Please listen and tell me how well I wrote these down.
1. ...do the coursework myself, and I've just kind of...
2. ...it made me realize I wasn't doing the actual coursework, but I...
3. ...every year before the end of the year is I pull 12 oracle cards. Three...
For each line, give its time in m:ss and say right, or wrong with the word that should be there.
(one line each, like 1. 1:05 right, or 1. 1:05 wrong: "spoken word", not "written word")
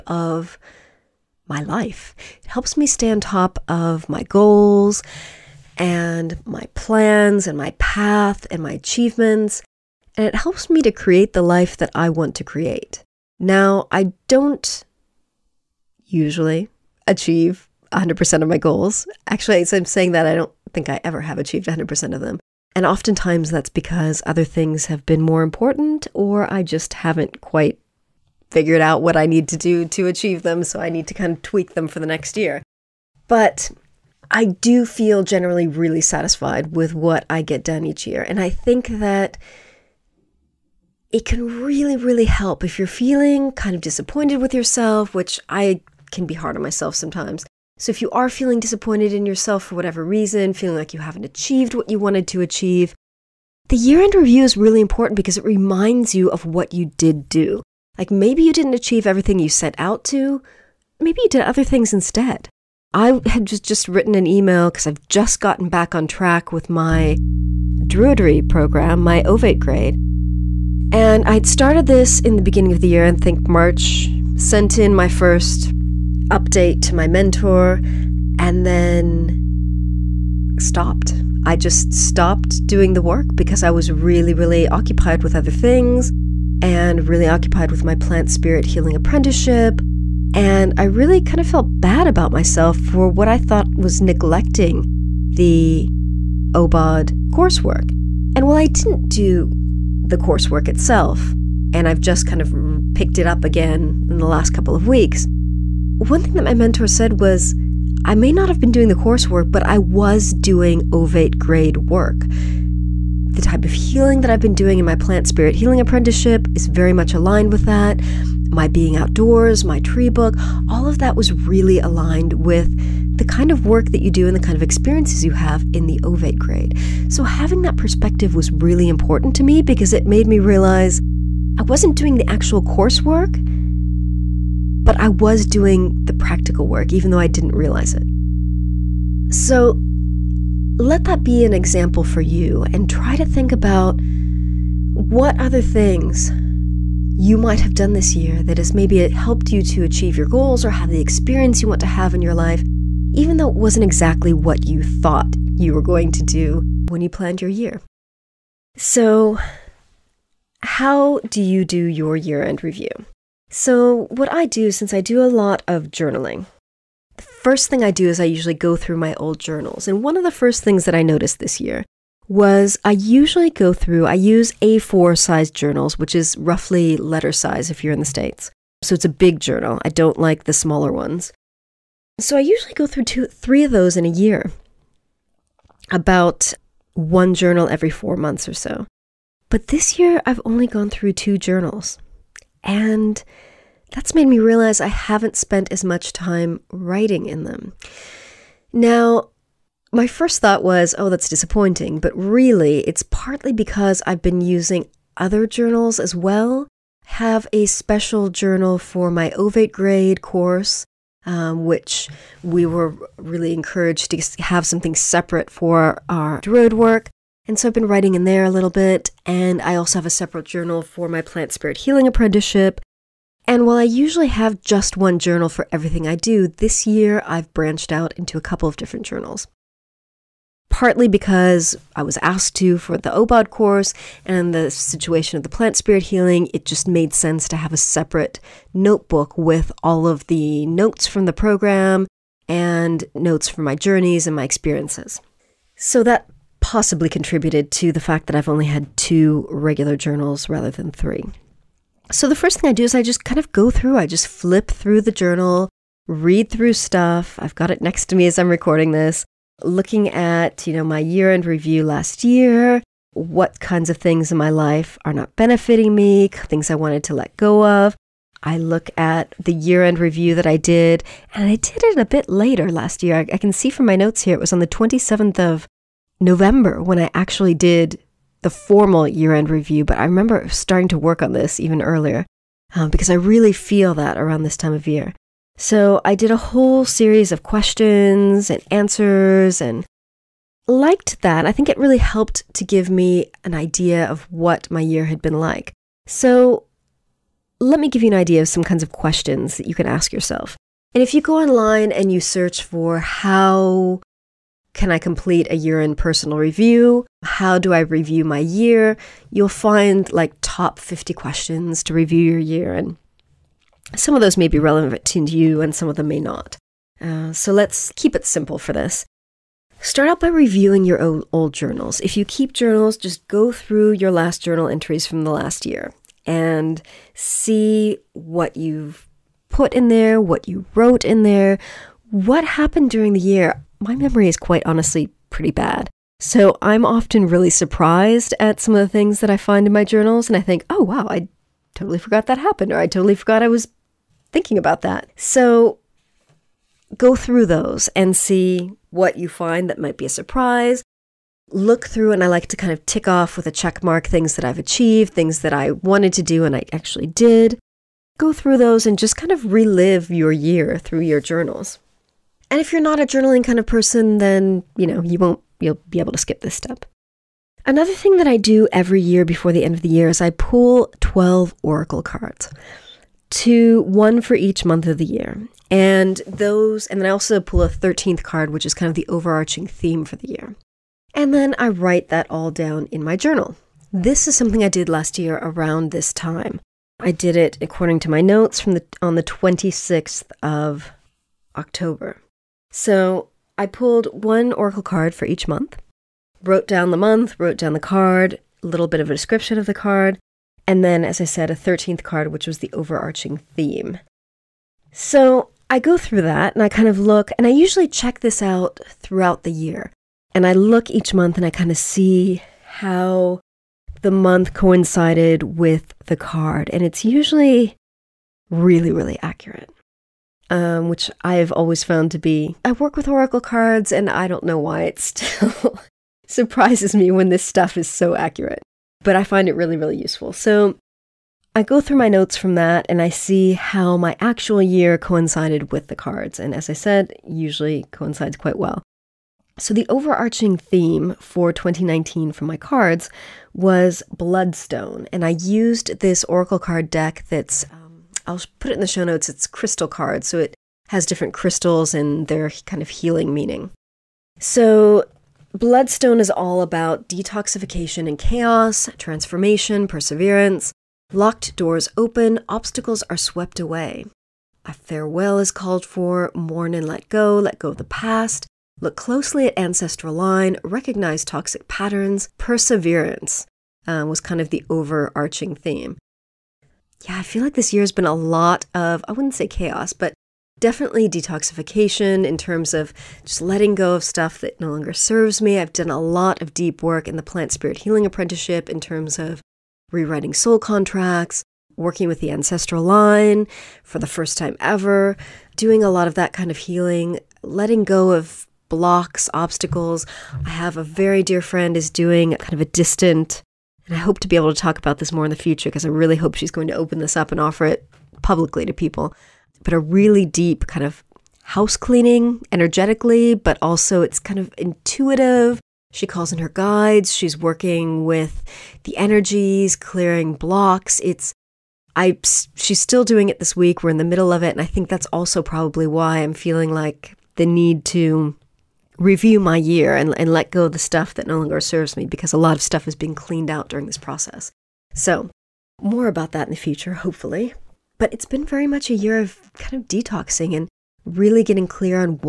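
1. 1:39 wrong: "itself", not "myself"
2. 2:09 right
3. 6:08 wrong: "Two", not "Three".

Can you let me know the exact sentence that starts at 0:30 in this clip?
So I need to kind of tweak them for the next year.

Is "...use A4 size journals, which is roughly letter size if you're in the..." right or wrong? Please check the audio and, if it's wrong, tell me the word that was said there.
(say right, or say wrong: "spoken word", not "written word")
right.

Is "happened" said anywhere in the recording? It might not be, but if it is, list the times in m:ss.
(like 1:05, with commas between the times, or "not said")
5:32, 5:42.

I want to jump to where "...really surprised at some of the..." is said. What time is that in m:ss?
5:37.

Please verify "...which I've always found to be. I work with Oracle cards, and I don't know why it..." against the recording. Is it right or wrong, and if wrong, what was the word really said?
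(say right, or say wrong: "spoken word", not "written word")
right.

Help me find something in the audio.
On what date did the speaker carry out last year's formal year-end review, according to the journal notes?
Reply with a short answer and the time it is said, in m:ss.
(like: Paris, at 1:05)
27th of November, at 4:34.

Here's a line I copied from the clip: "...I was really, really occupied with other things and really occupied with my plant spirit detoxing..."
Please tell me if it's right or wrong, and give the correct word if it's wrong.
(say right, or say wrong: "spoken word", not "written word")
wrong: "healing", not "detoxing".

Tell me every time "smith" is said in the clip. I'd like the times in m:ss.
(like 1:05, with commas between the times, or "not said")
not said.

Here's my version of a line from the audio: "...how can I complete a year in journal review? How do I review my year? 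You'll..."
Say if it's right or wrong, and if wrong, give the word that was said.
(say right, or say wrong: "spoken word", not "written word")
wrong: "personal", not "journal".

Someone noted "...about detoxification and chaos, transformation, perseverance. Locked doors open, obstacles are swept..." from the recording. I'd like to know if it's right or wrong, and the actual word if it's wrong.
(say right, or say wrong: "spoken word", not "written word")
right.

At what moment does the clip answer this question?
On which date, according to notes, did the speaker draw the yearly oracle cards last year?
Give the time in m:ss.
6:29.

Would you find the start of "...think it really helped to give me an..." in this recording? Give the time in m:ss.
4:51.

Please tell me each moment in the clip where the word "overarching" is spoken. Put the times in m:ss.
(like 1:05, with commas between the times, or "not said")
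6:19, 6:42, 7:19, 7:54.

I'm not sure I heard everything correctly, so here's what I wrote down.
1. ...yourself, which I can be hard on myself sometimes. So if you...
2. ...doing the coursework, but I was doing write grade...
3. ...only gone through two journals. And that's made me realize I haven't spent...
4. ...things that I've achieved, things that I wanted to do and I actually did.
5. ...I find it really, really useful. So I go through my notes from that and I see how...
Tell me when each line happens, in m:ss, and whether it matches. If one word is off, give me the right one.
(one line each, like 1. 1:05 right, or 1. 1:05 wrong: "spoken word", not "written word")
1. 0:44 right
2. 1:48 wrong: "ovate", not "write"
3. 3:10 right
4. 5:54 right
5. 7:09 right.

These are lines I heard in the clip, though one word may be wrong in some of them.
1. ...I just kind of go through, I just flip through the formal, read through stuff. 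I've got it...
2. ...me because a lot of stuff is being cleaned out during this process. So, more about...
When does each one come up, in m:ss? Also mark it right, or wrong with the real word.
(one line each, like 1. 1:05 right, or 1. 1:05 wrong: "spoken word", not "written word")
1. 4:12 wrong: "journal", not "formal"
2. 8:51 right.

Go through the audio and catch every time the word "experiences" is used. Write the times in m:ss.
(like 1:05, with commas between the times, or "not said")
2:04, 2:31, 4:04.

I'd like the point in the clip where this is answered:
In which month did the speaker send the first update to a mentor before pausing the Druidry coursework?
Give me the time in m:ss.
1:13.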